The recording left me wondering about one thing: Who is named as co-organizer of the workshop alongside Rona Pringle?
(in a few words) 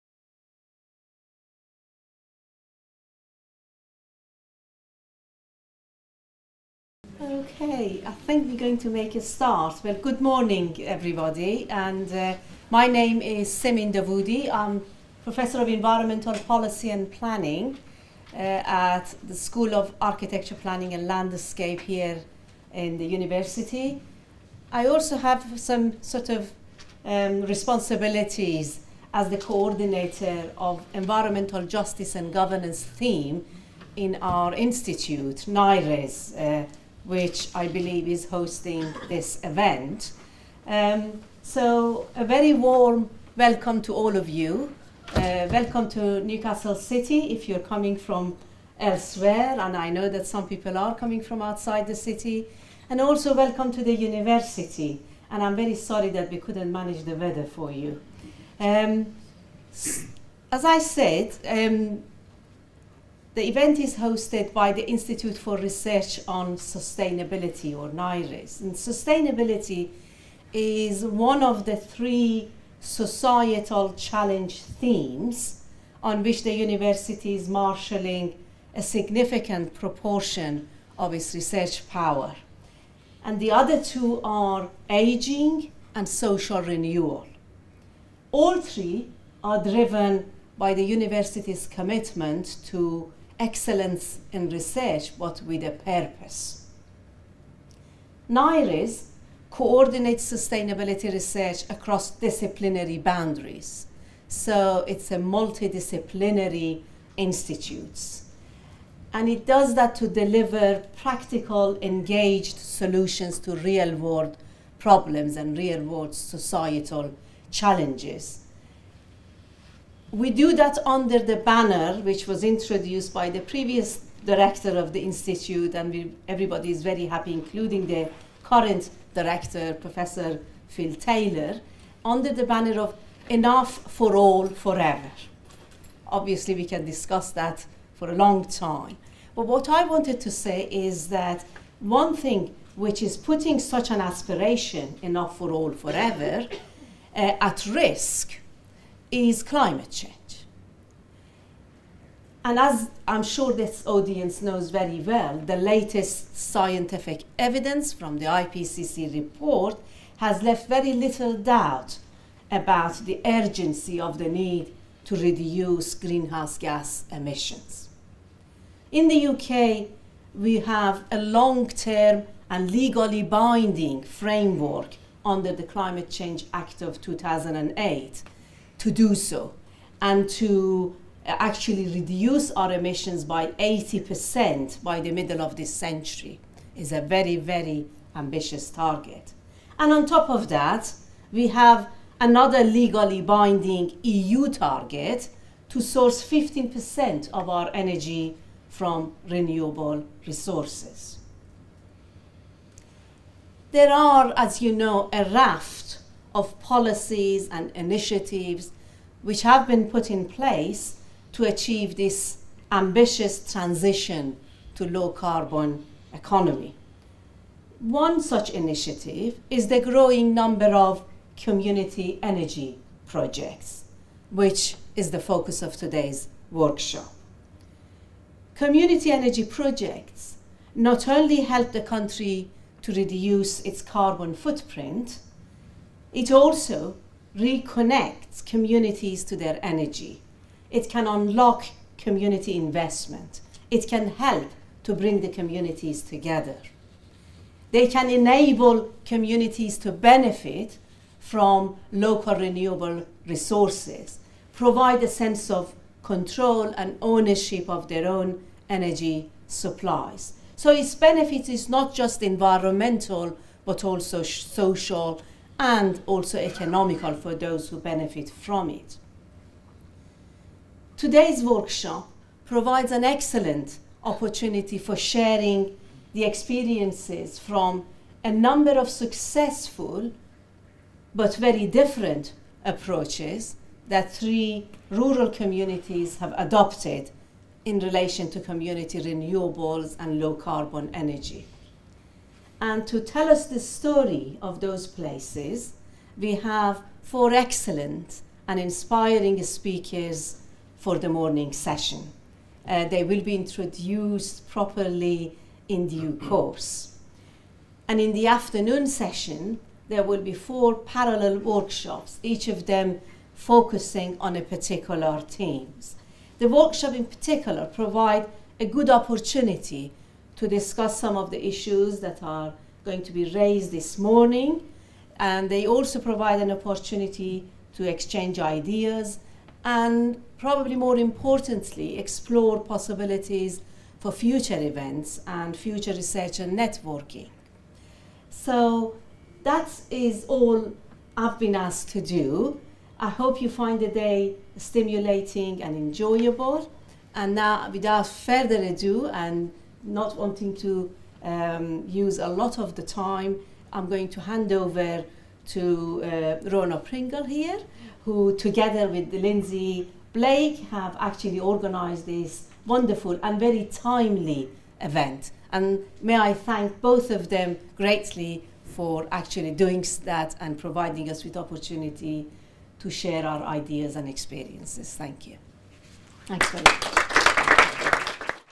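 Lindsay Blake.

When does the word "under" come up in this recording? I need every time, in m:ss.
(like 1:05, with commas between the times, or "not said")
2:00, 2:12, 2:55.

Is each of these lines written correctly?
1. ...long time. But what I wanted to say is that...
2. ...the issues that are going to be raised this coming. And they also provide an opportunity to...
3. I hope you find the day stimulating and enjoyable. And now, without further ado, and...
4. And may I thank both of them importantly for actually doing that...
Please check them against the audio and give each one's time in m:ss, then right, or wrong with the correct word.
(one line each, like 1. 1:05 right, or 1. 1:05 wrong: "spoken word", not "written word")
1. 2:18 right
2. 5:21 wrong: "morning", not "coming"
3. 5:42 right
4. 6:05 wrong: "greatly", not "importantly".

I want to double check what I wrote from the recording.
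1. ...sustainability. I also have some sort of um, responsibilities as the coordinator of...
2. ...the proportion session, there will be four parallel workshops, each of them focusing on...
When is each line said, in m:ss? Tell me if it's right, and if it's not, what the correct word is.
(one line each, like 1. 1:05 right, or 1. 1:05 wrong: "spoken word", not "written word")
1. 0:23 wrong: "university", not "sustainability"
2. 5:08 wrong: "afternoon", not "proportion".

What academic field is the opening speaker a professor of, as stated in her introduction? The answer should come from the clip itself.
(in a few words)
Environmental Policy and Planning.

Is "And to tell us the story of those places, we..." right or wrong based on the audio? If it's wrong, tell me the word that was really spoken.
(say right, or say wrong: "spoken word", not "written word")
right.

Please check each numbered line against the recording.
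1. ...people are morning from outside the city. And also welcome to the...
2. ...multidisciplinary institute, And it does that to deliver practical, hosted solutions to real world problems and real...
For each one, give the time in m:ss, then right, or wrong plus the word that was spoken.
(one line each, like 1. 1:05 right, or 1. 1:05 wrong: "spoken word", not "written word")
1. 0:50 wrong: "coming", not "morning"
2. 1:45 wrong: "engaged", not "hosted".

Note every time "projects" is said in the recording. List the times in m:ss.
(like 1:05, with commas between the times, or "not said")
3:43, 3:49.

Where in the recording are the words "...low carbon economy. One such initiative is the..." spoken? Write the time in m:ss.
3:34.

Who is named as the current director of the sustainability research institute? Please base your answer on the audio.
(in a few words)
Phil Taylor.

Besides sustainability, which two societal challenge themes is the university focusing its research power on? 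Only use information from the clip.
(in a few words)
aging and social renewal.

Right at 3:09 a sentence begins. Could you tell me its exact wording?
And on top of that, we have another legally binding EU target to source 15% of our energy from renewable resources.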